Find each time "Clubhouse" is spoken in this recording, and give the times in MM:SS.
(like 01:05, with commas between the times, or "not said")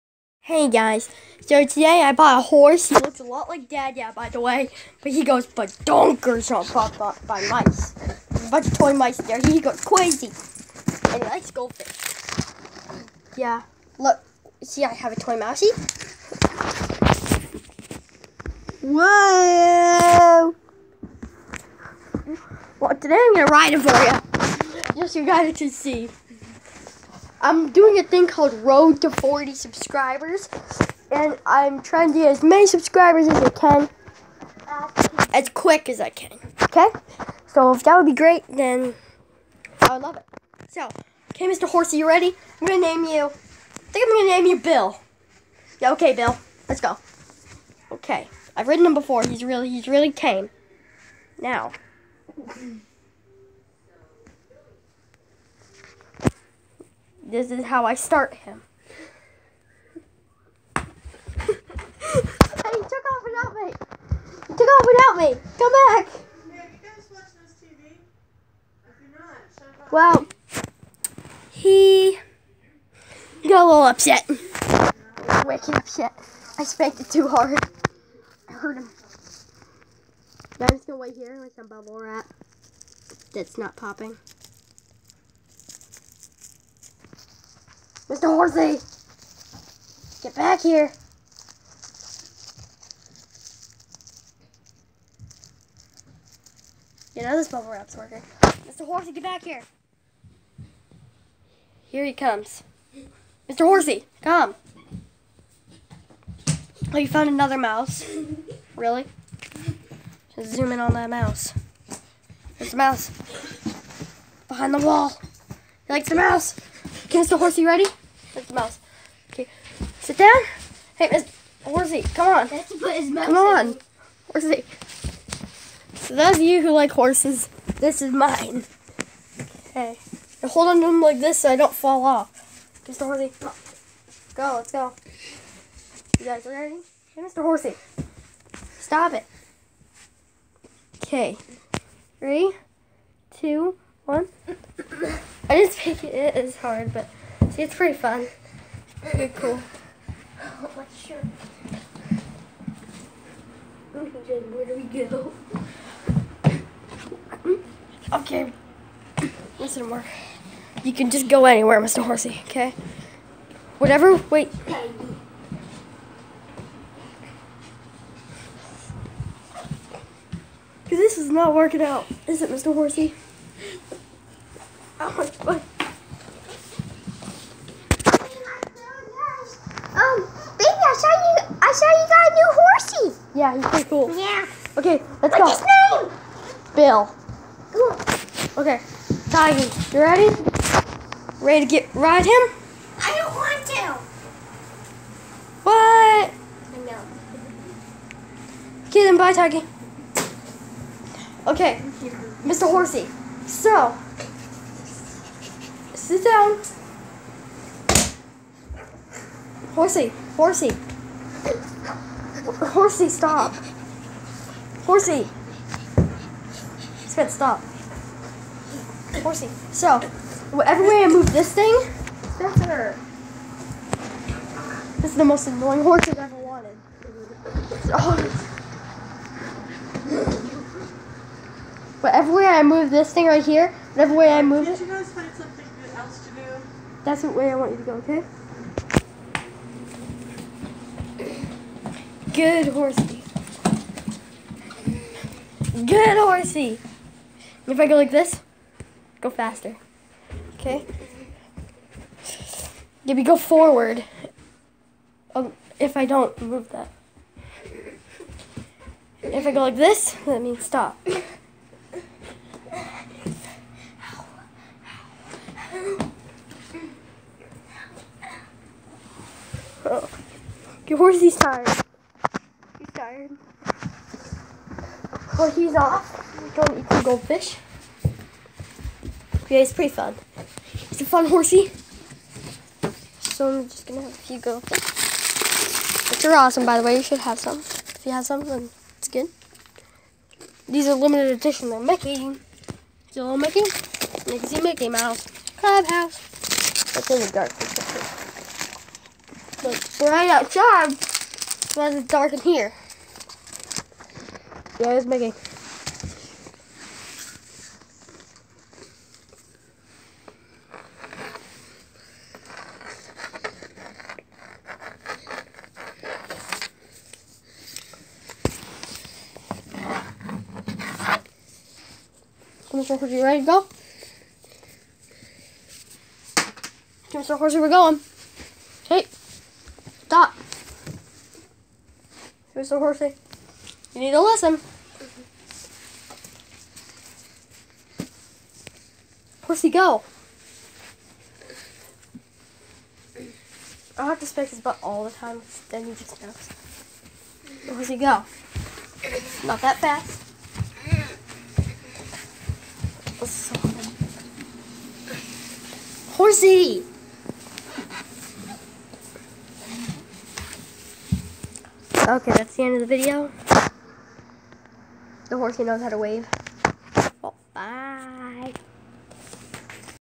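04:55.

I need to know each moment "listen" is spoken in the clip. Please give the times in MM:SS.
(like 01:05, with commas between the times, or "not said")
02:39, 05:34.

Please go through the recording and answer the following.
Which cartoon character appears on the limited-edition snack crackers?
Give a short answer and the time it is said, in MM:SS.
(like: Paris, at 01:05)
Mickey Mouse, at 04:54.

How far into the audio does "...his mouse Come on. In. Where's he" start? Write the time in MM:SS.
02:02.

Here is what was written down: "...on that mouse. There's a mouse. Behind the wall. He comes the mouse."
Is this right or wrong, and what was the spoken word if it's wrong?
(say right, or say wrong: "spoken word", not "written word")
wrong: "likes", not "comes".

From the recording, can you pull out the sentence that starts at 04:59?
But right outside, why is it dark in here?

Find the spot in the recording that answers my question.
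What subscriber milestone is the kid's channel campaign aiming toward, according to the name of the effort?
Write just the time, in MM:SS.
00:28.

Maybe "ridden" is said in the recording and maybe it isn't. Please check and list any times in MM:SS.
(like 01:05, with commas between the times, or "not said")
00:48.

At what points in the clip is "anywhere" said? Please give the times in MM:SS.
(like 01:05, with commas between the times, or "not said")
02:41.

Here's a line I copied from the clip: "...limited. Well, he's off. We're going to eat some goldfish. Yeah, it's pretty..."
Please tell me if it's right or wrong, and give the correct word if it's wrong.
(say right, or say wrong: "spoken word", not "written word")
wrong: "tired", not "limited".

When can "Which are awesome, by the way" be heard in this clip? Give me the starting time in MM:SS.
04:46.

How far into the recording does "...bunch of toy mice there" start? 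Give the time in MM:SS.
00:08.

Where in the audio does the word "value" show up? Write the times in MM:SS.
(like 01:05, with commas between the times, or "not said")
not said.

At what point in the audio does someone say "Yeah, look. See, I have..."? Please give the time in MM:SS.
00:13.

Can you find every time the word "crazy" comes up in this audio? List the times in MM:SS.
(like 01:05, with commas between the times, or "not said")
00:09.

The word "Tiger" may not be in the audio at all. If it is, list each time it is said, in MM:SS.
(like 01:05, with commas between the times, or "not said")
03:09, 03:19.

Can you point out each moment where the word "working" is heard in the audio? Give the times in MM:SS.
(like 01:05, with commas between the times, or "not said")
01:37, 02:51.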